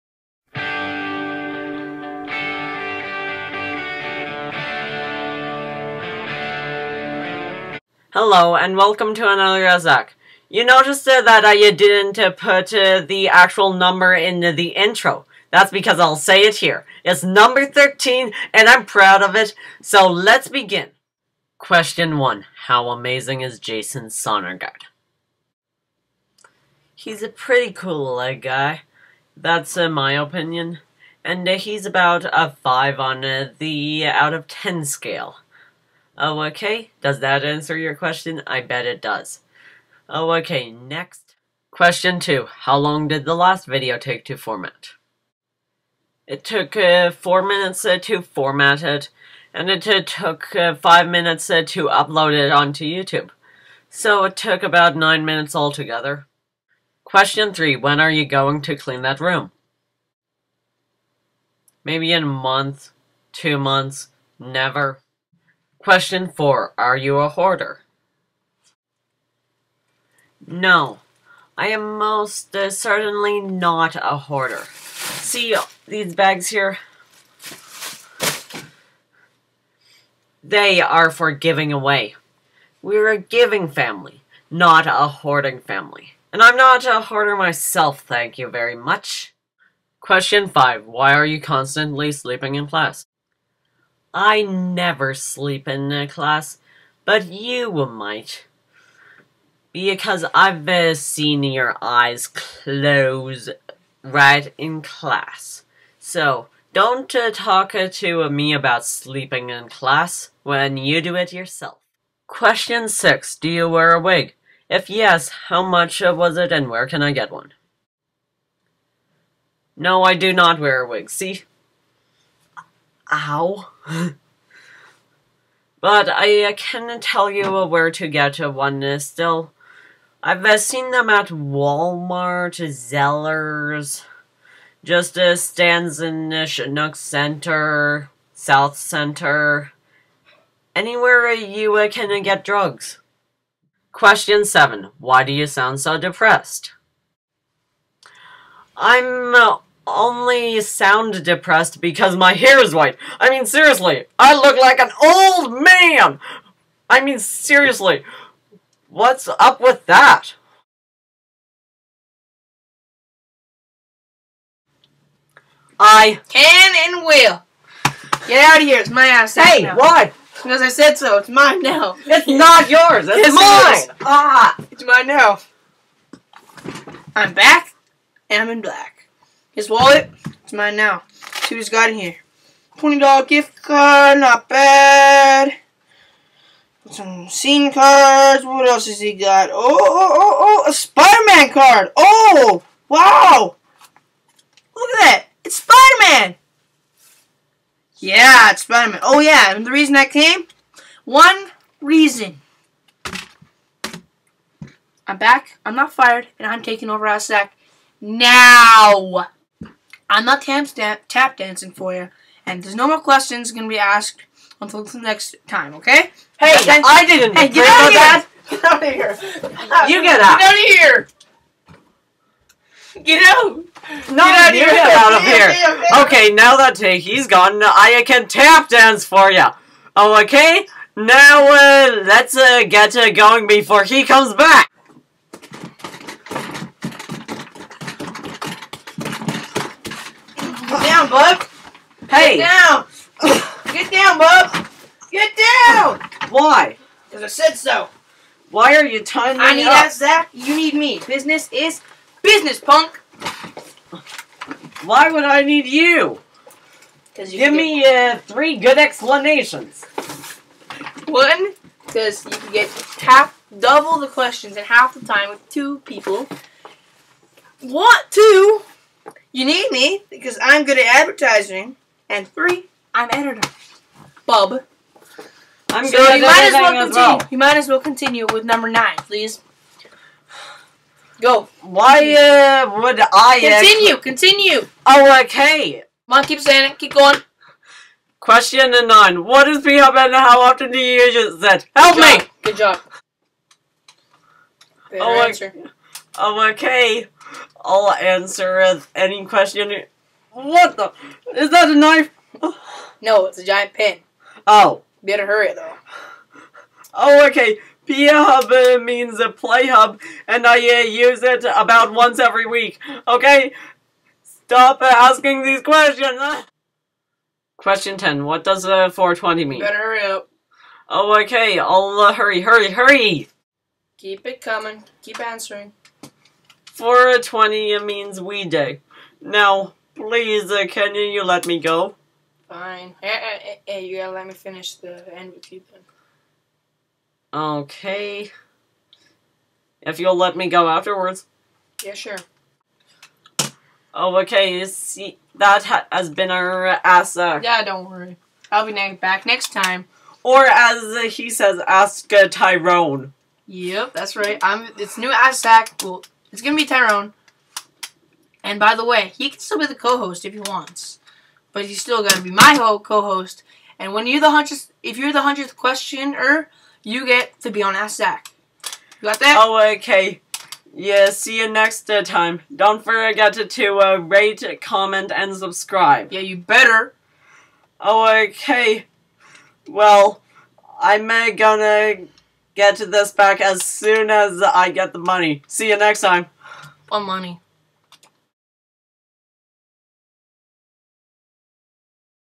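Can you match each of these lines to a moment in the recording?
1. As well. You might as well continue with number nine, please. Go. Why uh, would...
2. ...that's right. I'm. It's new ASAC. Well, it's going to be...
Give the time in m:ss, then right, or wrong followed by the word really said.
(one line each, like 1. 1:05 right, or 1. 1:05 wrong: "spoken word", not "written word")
1. 4:36 right
2. 5:53 right.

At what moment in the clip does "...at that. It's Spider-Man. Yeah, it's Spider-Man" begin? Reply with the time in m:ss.
3:14.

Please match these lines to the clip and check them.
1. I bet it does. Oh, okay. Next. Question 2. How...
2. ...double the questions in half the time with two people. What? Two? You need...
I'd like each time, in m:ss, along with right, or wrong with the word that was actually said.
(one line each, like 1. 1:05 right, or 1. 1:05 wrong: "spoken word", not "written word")
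1. 0:38 right
2. 4:23 right.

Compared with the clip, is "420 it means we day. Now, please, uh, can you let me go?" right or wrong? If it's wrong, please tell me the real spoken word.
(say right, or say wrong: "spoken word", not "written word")
right.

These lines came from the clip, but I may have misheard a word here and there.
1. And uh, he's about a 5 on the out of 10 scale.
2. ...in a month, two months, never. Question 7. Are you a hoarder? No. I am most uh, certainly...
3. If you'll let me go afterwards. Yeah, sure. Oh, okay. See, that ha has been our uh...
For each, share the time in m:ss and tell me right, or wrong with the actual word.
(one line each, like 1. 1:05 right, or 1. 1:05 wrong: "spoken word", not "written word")
1. 0:31 right
2. 1:02 wrong: "4", not "7"
3. 5:39 right.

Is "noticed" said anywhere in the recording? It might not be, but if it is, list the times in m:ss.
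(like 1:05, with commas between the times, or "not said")
0:10.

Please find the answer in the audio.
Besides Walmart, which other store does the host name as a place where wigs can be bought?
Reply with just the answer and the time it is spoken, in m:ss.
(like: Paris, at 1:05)
Zellers, at 2:12.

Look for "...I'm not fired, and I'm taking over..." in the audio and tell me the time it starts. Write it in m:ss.
3:25.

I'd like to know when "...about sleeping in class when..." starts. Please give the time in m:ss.
1:48.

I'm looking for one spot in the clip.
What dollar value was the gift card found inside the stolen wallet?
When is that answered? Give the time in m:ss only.
3:02.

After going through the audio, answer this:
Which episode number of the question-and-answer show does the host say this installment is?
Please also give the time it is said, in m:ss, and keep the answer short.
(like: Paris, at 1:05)
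13, at 0:17.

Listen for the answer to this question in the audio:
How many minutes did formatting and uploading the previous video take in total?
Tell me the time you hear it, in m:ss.
0:54.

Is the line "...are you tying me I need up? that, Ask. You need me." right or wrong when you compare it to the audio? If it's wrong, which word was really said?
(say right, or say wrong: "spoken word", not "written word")
wrong: "Zach", not "Ask".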